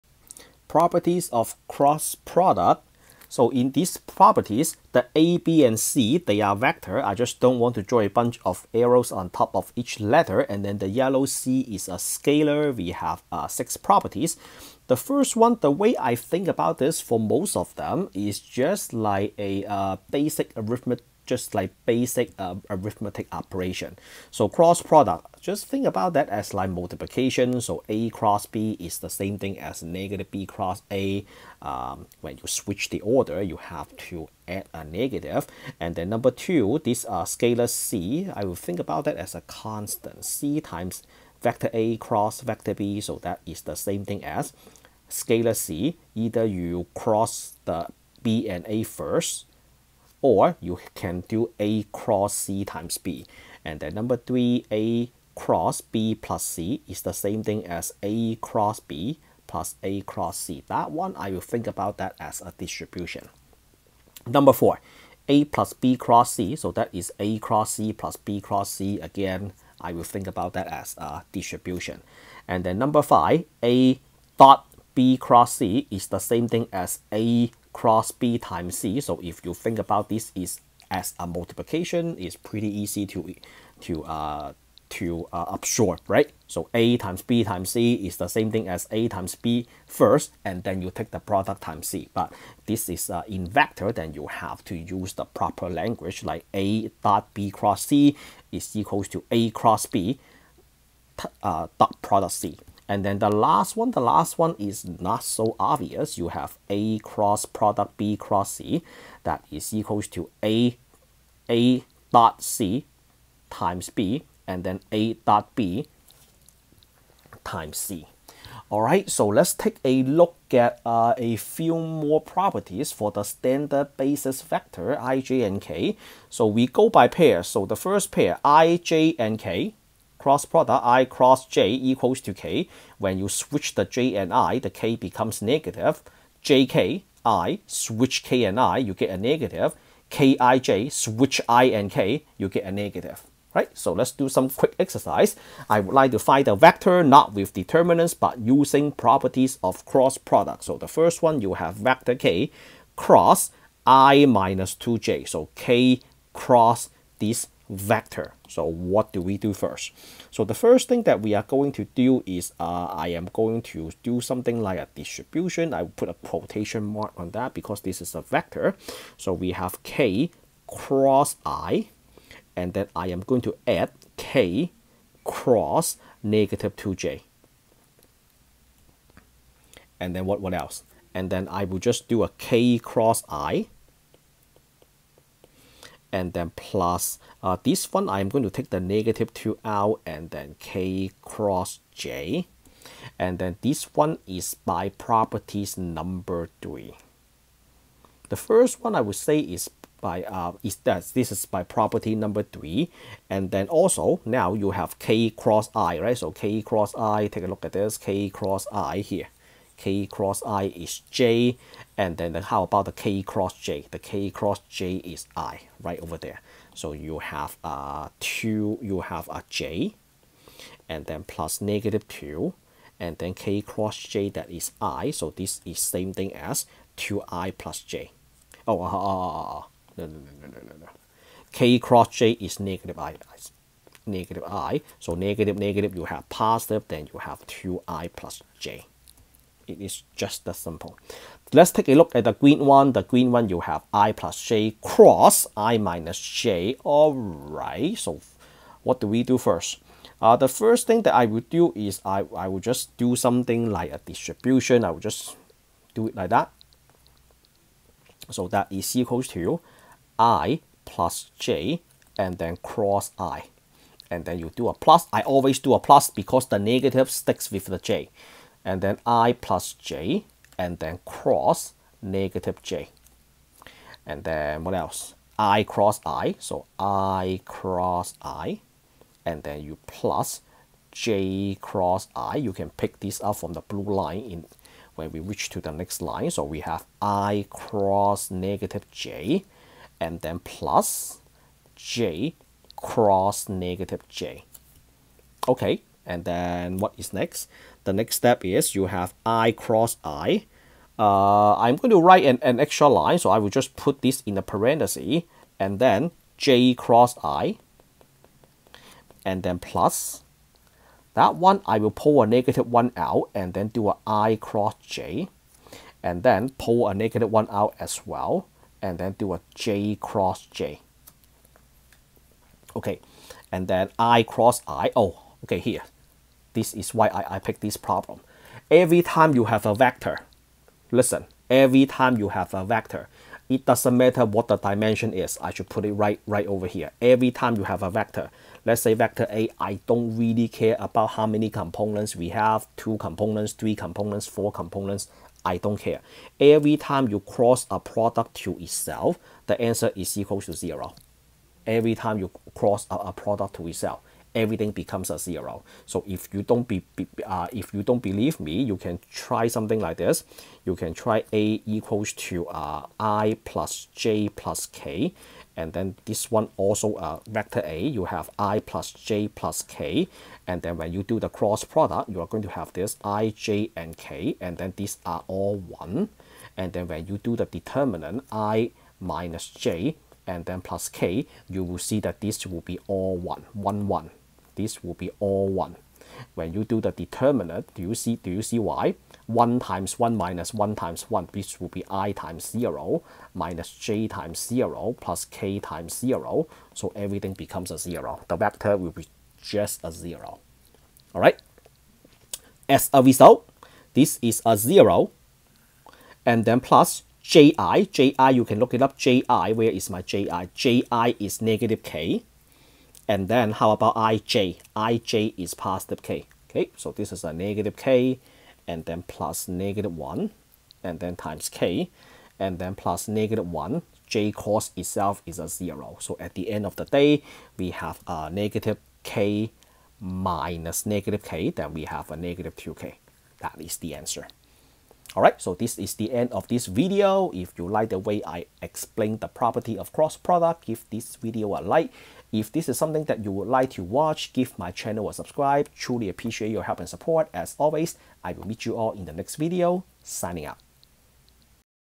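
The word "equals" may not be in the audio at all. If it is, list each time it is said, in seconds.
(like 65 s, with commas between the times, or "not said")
98 s, 109 s, 131 s, 258 s, 350 s, 361 s.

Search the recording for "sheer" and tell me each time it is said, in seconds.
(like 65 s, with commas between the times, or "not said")
not said.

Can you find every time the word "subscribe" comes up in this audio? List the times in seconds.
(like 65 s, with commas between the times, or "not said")
445 s.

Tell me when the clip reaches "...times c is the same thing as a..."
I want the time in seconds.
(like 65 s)
87 s.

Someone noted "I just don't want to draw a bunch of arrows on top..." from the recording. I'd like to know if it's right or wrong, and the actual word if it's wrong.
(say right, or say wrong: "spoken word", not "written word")
right.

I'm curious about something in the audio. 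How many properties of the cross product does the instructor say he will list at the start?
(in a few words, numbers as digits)
6.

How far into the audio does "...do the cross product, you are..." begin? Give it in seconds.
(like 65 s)
371 s.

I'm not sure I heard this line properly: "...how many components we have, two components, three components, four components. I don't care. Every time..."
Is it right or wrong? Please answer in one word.
right.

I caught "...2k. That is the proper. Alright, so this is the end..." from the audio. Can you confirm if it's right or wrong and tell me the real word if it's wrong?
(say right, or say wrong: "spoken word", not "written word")
wrong: "answer", not "proper".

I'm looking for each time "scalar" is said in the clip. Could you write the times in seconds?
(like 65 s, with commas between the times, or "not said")
12 s, 37 s, 45 s.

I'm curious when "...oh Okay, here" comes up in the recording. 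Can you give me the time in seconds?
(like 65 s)
324 s.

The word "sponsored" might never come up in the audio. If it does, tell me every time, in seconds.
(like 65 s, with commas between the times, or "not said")
not said.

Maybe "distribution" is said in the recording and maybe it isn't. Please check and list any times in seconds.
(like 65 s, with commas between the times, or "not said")
62 s, 71 s, 164 s, 253 s.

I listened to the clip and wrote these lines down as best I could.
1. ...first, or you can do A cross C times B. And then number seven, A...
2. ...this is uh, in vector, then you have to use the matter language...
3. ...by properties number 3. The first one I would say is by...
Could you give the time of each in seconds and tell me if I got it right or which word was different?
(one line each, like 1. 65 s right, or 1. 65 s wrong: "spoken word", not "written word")
1. 48 s wrong: "three", not "seven"
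2. 92 s wrong: "proper", not "matter"
3. 194 s right.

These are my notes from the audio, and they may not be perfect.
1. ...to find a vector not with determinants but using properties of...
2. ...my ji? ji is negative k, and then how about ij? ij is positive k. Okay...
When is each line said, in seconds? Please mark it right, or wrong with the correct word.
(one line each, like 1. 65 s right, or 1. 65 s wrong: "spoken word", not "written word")
1. 146 s right
2. 409 s right.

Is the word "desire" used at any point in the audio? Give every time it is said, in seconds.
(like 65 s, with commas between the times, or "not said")
not said.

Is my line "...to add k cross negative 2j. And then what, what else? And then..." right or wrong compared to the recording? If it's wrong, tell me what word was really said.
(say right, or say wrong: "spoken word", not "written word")
right.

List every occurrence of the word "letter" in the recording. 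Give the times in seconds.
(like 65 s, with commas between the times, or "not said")
9 s.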